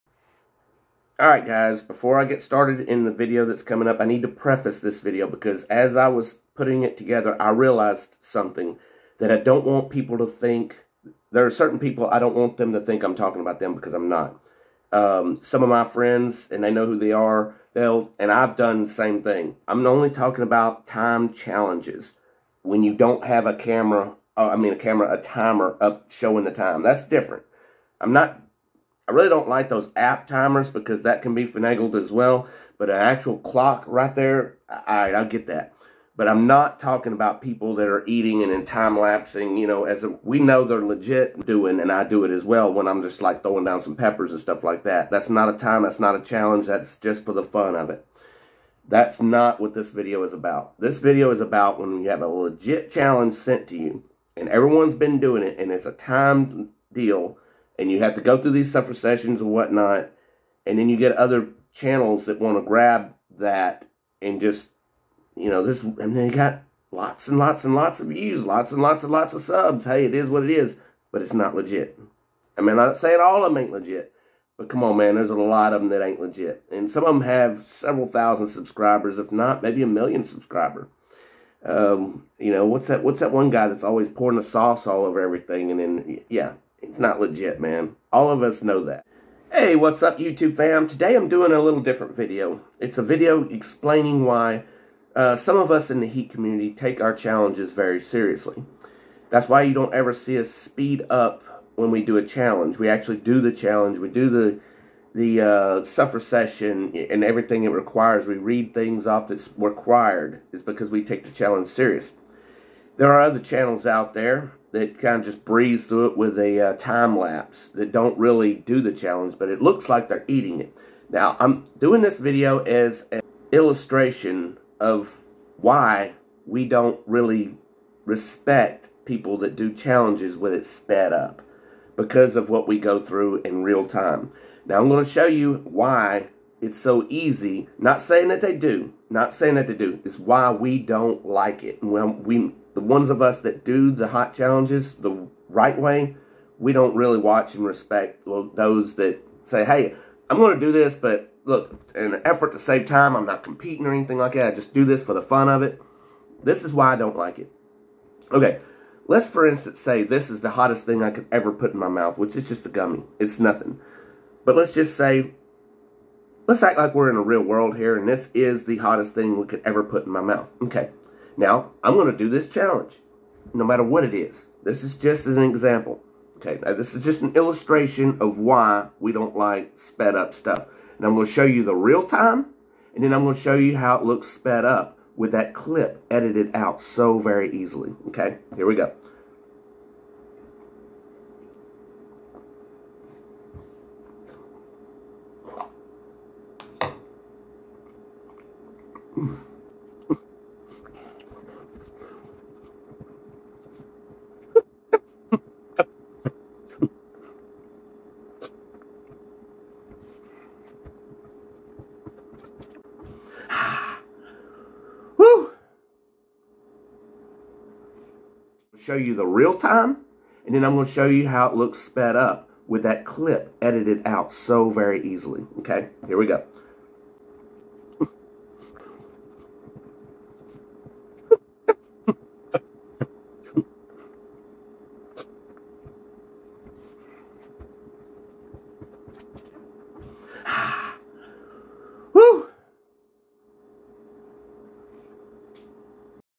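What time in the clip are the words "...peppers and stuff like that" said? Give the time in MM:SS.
00:43.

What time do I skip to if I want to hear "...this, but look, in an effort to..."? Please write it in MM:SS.
02:30.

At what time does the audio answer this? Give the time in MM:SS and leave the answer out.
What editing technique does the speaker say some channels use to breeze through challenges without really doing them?
01:56.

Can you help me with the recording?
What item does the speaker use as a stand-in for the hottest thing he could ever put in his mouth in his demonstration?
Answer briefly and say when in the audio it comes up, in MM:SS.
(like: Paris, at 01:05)
A gummy, at 02:42.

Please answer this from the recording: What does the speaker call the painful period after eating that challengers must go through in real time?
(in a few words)
Suffer session.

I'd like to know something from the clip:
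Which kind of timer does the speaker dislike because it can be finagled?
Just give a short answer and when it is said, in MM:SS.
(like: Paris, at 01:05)
App timers, at 00:29.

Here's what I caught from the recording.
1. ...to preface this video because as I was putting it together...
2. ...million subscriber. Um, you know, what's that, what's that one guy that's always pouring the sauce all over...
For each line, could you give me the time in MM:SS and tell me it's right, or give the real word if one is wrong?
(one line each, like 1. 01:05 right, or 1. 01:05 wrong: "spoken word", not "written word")
1. 00:04 right
2. 01:19 right.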